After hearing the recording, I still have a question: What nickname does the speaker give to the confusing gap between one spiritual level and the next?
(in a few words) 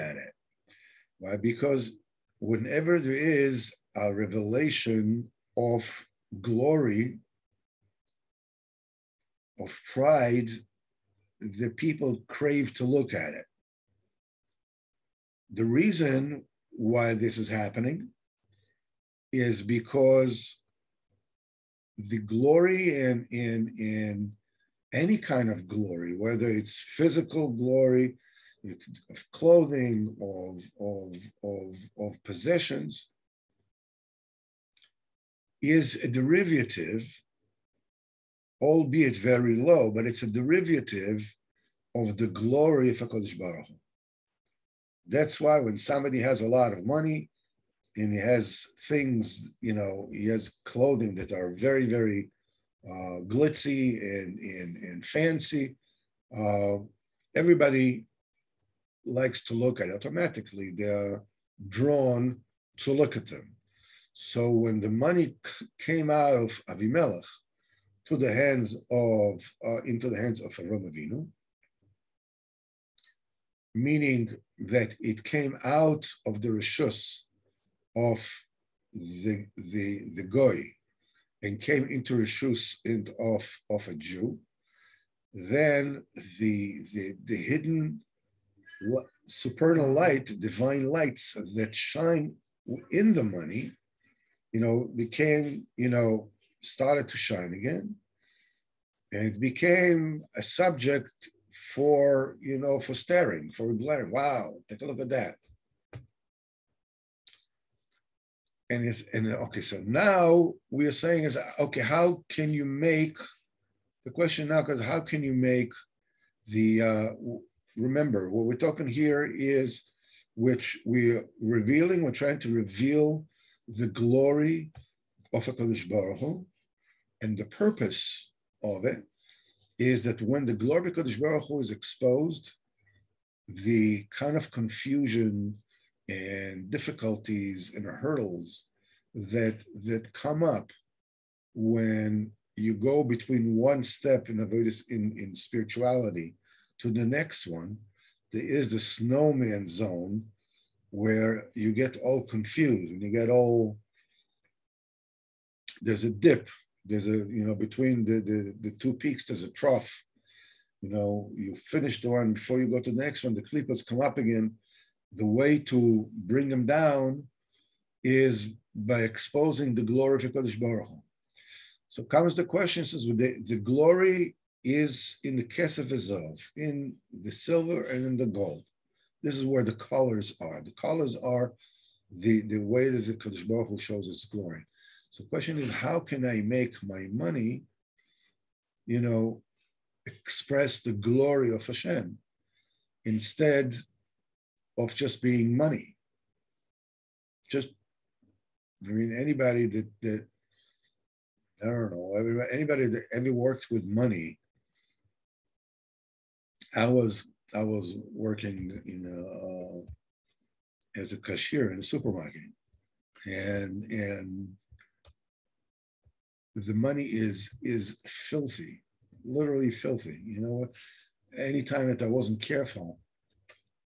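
the snowman zone.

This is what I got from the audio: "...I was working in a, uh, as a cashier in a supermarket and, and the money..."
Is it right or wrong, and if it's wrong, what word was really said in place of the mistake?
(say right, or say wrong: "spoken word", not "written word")
right.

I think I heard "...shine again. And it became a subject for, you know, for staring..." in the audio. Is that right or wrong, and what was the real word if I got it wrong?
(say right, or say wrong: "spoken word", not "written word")
right.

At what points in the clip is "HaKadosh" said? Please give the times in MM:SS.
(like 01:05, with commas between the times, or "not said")
00:42, 02:05, 02:10, 02:50.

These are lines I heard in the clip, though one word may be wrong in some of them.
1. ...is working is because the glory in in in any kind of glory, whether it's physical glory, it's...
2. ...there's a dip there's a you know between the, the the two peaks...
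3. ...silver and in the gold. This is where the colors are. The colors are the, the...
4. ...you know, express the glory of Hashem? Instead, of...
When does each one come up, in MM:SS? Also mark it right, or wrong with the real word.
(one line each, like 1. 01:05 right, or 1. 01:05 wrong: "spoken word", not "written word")
1. 00:17 wrong: "happening", not "working"
2. 02:35 right
3. 02:57 right
4. 03:08 right.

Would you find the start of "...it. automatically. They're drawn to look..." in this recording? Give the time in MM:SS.
00:59.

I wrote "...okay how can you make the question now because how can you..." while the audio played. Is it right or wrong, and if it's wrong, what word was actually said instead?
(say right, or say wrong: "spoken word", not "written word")
right.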